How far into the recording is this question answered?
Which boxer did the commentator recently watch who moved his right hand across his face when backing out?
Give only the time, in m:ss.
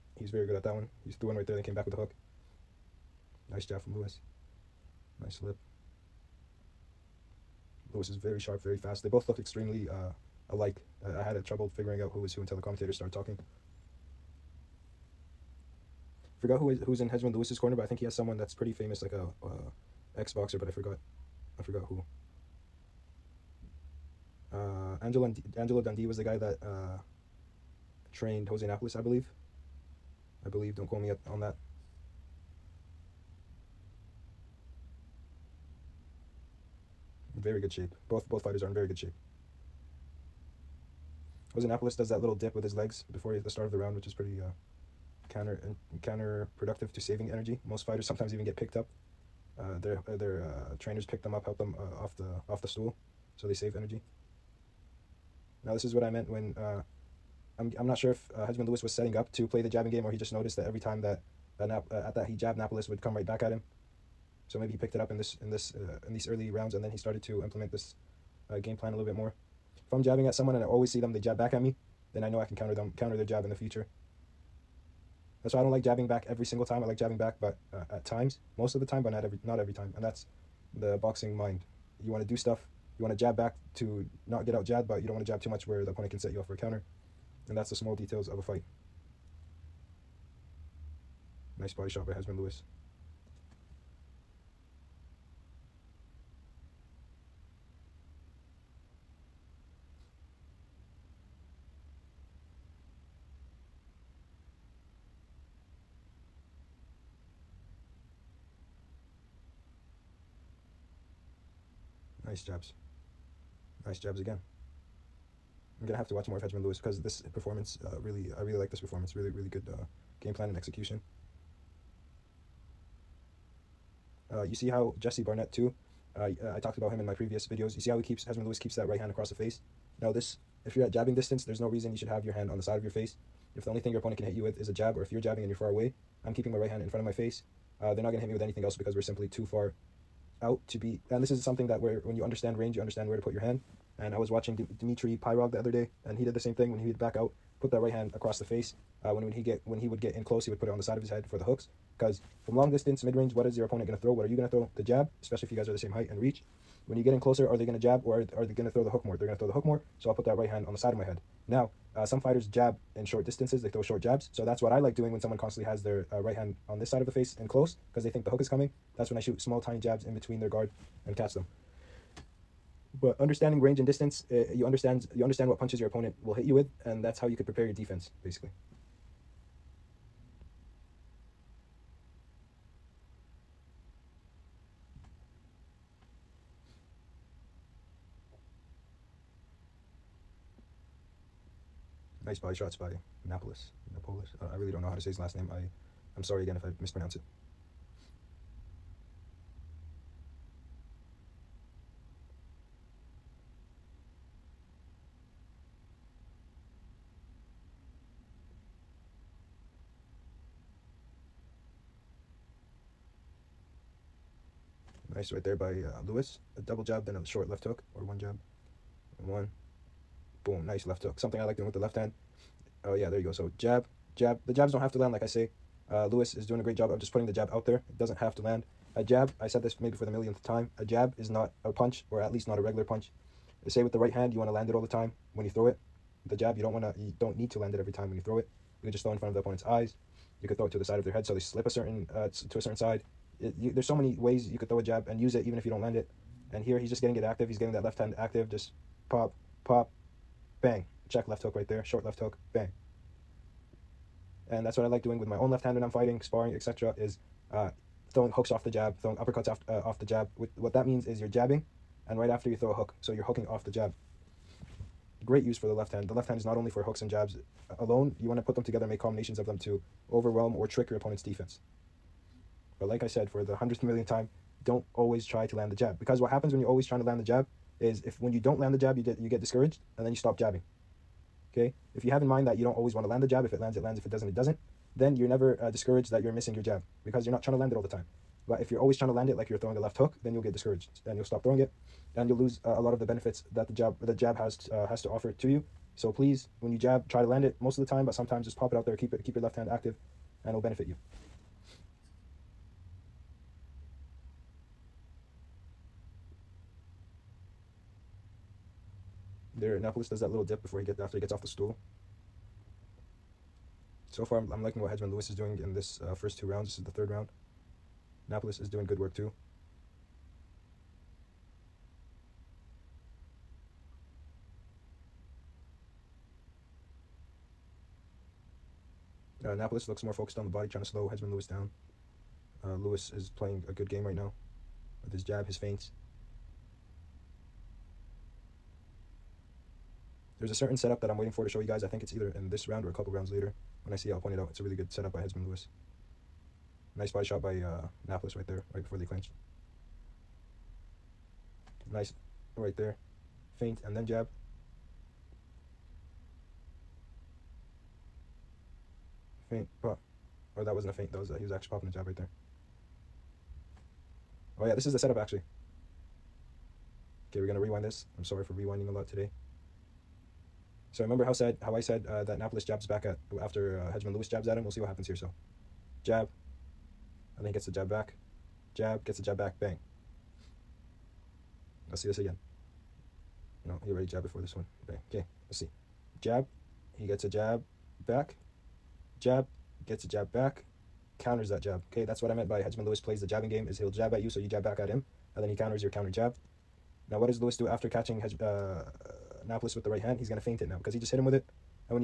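2:24.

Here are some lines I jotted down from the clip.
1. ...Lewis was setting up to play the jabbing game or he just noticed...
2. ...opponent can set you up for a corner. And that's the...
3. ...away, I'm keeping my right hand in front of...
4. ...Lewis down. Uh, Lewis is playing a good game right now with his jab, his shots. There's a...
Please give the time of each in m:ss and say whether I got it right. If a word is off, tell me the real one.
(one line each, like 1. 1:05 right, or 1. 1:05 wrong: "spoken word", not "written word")
1. 0:58 right
2. 1:25 wrong: "counter", not "corner"
3. 2:15 right
4. 5:31 wrong: "feints", not "shots".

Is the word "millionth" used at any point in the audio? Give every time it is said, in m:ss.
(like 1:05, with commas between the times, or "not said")
3:50, 4:33.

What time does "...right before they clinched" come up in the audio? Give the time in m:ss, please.
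5:48.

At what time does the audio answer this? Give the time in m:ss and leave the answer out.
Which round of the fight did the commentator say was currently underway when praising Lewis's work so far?
5:16.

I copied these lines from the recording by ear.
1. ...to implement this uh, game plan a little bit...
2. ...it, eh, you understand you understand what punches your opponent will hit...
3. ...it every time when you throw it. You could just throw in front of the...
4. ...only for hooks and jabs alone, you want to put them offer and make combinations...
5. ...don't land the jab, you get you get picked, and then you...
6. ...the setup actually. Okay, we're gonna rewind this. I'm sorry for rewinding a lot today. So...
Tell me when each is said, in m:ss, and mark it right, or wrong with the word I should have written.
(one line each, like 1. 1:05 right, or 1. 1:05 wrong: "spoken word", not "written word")
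1. 1:07 right
2. 2:54 right
3. 3:57 right
4. 4:26 wrong: "together", not "offer"
5. 4:38 wrong: "discouraged", not "picked"
6. 6:04 right.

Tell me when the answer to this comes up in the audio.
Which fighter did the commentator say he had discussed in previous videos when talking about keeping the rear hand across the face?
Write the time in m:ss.
2:04.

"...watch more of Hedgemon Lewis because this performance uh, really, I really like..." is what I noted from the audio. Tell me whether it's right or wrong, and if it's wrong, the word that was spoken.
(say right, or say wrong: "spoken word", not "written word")
right.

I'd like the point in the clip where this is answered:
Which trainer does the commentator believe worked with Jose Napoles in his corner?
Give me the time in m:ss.
0:25.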